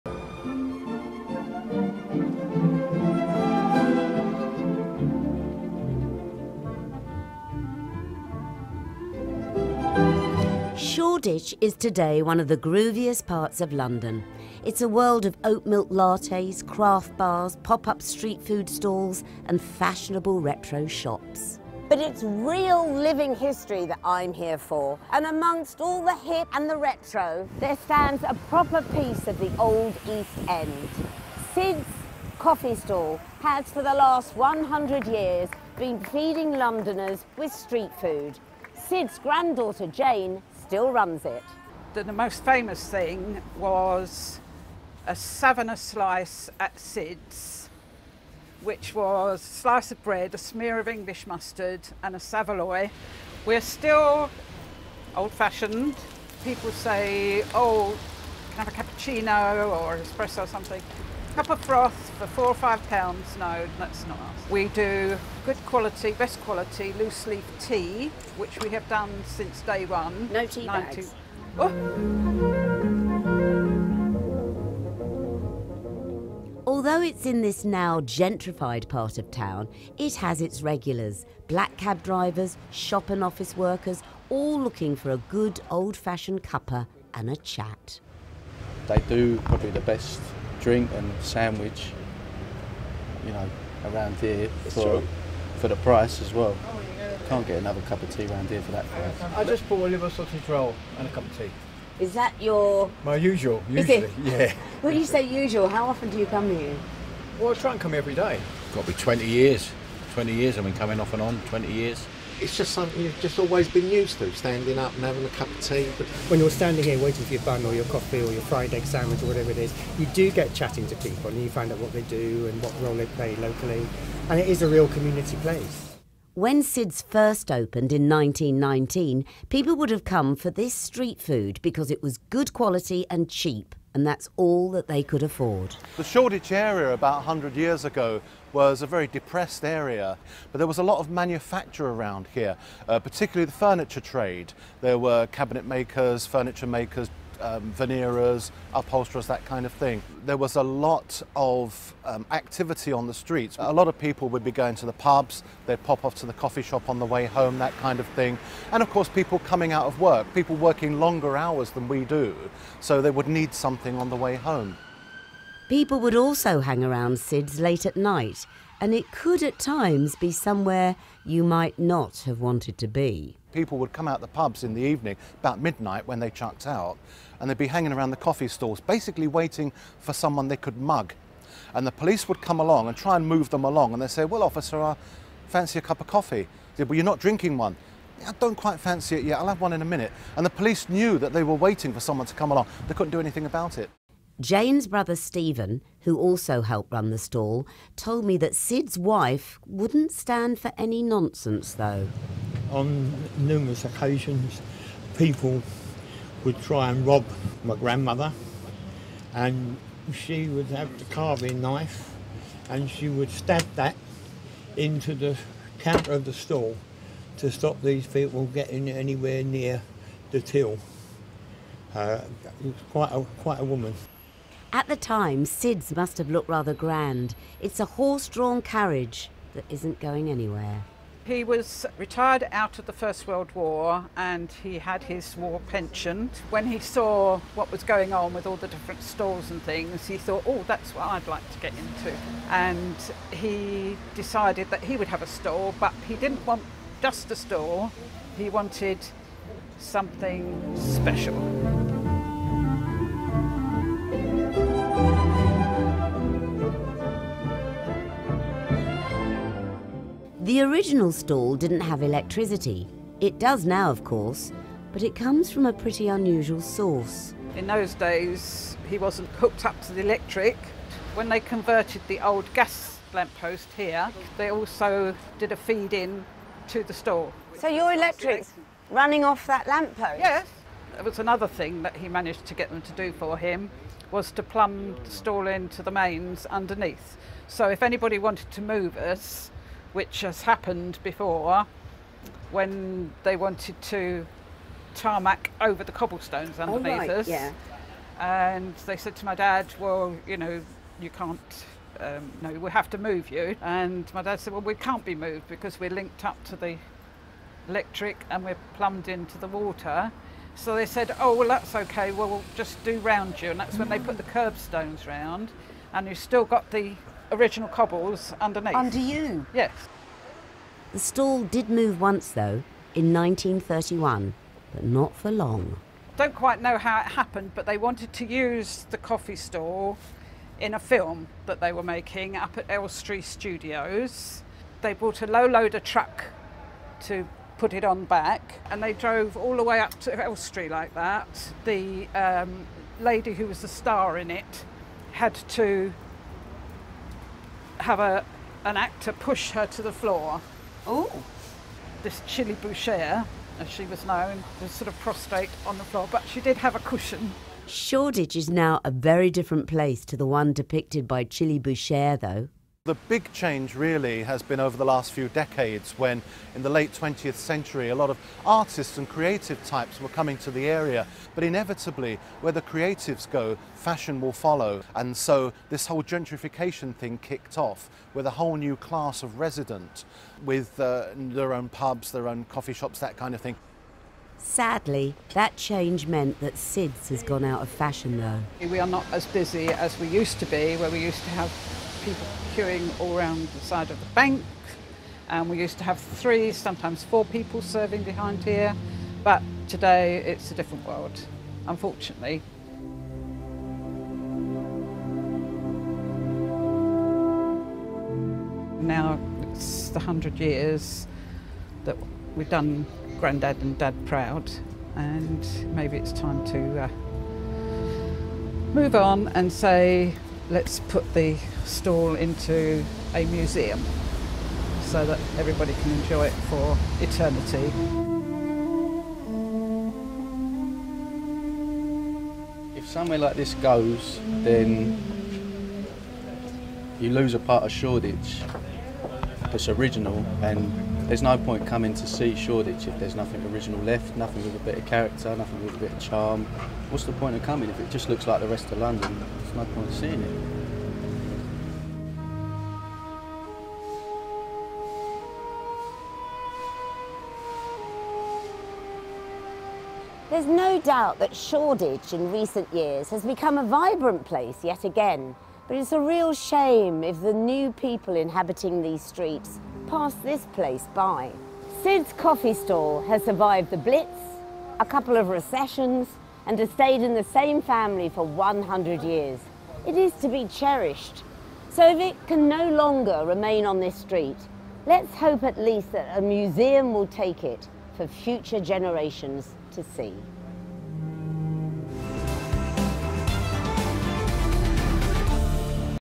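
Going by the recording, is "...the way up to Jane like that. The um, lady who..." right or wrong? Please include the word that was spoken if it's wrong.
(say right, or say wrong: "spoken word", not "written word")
wrong: "Elstree", not "Jane".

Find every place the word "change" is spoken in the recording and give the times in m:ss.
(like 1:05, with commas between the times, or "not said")
6:03, 6:25.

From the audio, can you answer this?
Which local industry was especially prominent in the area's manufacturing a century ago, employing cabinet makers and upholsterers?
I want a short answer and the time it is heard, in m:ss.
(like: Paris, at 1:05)
furniture trade, at 2:23.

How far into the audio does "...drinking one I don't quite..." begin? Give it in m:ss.
3:07.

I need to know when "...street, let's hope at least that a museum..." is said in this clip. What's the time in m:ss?
8:03.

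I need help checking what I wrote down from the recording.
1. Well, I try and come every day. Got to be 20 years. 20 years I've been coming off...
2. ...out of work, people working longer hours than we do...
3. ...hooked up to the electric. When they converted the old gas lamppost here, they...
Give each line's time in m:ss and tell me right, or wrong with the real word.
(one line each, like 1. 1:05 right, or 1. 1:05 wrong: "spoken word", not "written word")
1. 1:47 right
2. 2:39 right
3. 4:29 right.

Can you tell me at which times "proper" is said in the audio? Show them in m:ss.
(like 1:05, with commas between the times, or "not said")
0:28.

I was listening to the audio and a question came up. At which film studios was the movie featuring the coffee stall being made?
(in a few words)
Elstree Studios.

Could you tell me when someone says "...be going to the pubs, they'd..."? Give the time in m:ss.
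2:34.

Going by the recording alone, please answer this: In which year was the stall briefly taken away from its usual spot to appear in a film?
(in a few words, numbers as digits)
1931.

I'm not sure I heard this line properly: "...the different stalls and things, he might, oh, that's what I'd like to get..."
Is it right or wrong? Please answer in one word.
wrong.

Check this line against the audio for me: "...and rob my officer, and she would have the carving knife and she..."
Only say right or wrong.
wrong.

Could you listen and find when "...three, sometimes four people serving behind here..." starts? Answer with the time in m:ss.
6:35.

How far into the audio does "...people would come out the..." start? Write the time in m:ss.
2:53.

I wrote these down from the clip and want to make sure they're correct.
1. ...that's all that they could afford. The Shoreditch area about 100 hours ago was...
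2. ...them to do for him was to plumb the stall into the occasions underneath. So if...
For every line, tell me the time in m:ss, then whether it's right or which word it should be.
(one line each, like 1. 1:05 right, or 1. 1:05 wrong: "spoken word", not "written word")
1. 2:14 wrong: "years", not "hours"
2. 4:42 wrong: "mains", not "occasions".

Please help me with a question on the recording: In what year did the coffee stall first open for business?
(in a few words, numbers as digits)
1919.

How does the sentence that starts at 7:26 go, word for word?
What's the point of coming if it just looks like the rest of London?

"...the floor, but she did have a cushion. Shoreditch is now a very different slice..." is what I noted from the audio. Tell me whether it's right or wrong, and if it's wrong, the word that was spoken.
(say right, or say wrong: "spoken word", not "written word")
wrong: "place", not "slice".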